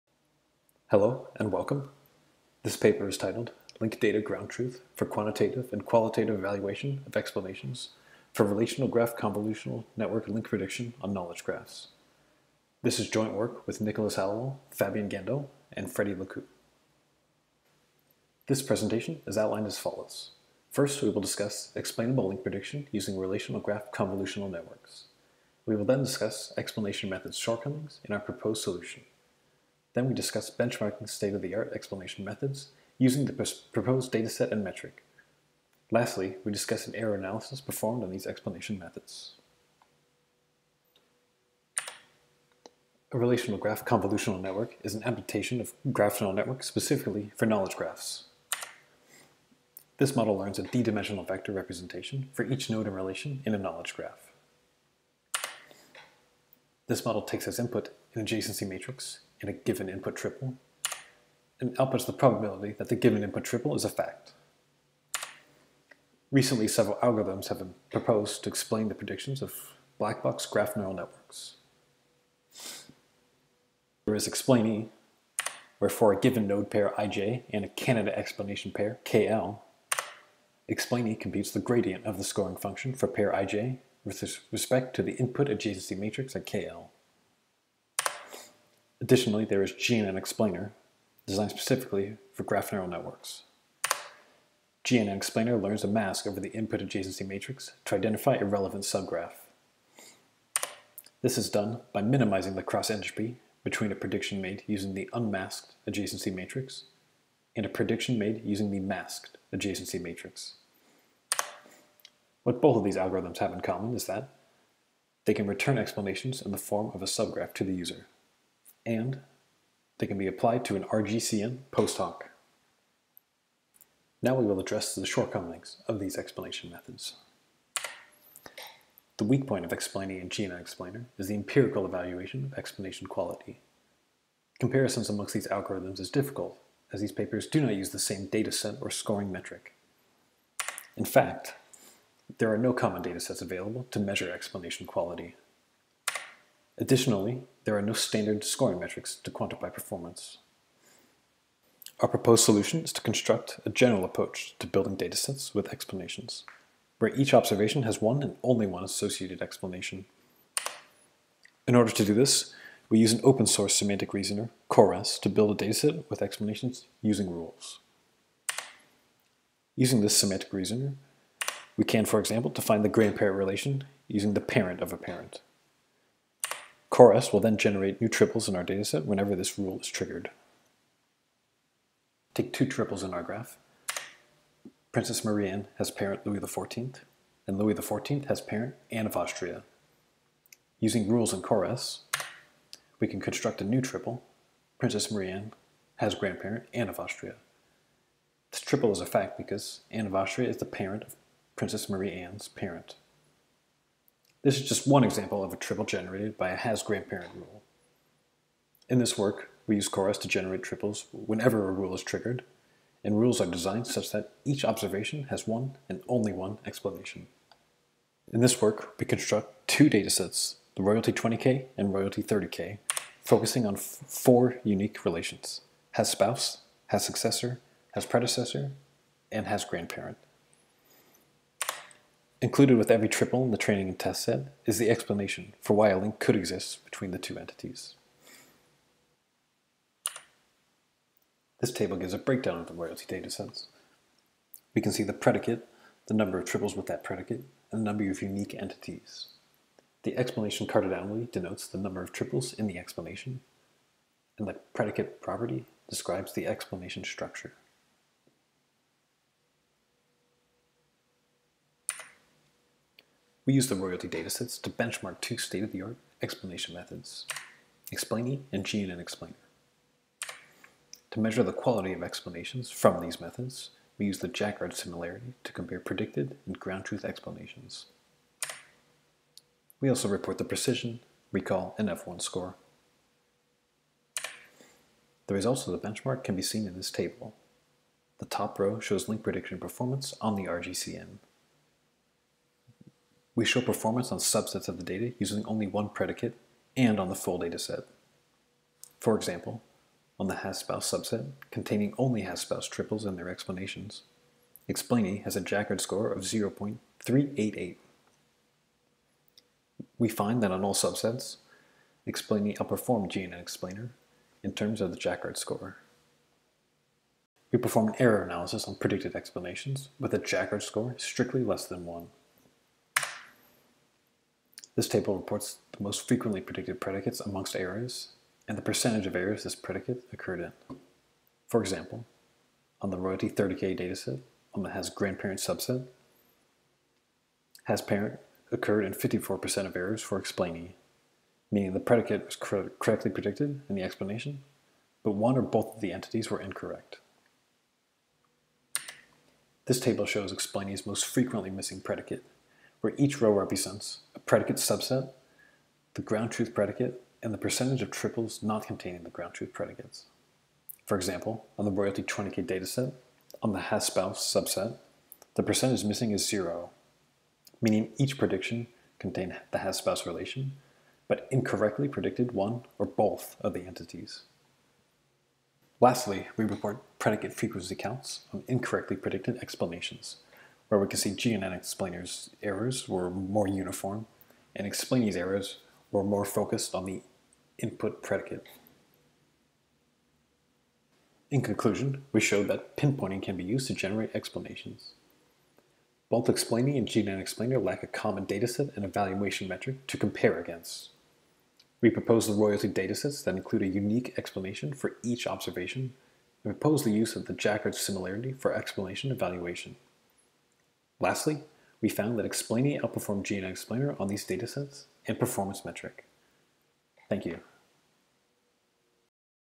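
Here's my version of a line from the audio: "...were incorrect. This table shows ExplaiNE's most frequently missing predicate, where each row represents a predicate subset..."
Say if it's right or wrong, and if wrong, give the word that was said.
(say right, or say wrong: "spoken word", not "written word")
right.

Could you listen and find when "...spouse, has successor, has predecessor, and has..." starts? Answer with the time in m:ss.
3:46.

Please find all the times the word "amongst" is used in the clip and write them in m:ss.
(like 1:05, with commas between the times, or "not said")
2:15, 5:27.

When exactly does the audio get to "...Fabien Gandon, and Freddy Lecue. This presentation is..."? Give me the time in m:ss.
0:14.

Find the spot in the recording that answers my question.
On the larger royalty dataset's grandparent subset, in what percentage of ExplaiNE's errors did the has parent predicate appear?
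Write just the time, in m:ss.
5:38.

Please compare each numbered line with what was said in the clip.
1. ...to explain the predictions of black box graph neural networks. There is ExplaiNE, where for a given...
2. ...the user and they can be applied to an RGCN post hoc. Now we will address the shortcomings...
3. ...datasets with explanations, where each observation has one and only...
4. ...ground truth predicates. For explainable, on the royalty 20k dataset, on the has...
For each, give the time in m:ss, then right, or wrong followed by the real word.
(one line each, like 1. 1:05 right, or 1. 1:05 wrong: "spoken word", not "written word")
1. 1:08 right
2. 1:57 right
3. 2:34 right
4. 5:59 wrong: "example", not "explainable".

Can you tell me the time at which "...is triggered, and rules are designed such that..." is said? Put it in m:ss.
3:31.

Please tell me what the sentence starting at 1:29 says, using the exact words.
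Additionally, there is GNN Explainer, designed specifically for graph neural networks.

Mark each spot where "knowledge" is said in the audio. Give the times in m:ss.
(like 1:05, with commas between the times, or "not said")
0:11, 0:47, 0:53.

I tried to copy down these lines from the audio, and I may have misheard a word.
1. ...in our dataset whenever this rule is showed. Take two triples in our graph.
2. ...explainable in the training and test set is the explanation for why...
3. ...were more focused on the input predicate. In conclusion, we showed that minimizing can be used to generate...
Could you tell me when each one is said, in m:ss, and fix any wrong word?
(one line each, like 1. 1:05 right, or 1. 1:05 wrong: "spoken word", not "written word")
1. 2:58 wrong: "triggered", not "showed"
2. 3:53 wrong: "triple", not "explainable"
3. 6:25 wrong: "pinpointing", not "minimizing".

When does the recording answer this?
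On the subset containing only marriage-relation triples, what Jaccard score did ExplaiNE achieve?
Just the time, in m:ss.
5:06.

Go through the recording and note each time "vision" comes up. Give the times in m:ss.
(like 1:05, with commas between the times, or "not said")
not said.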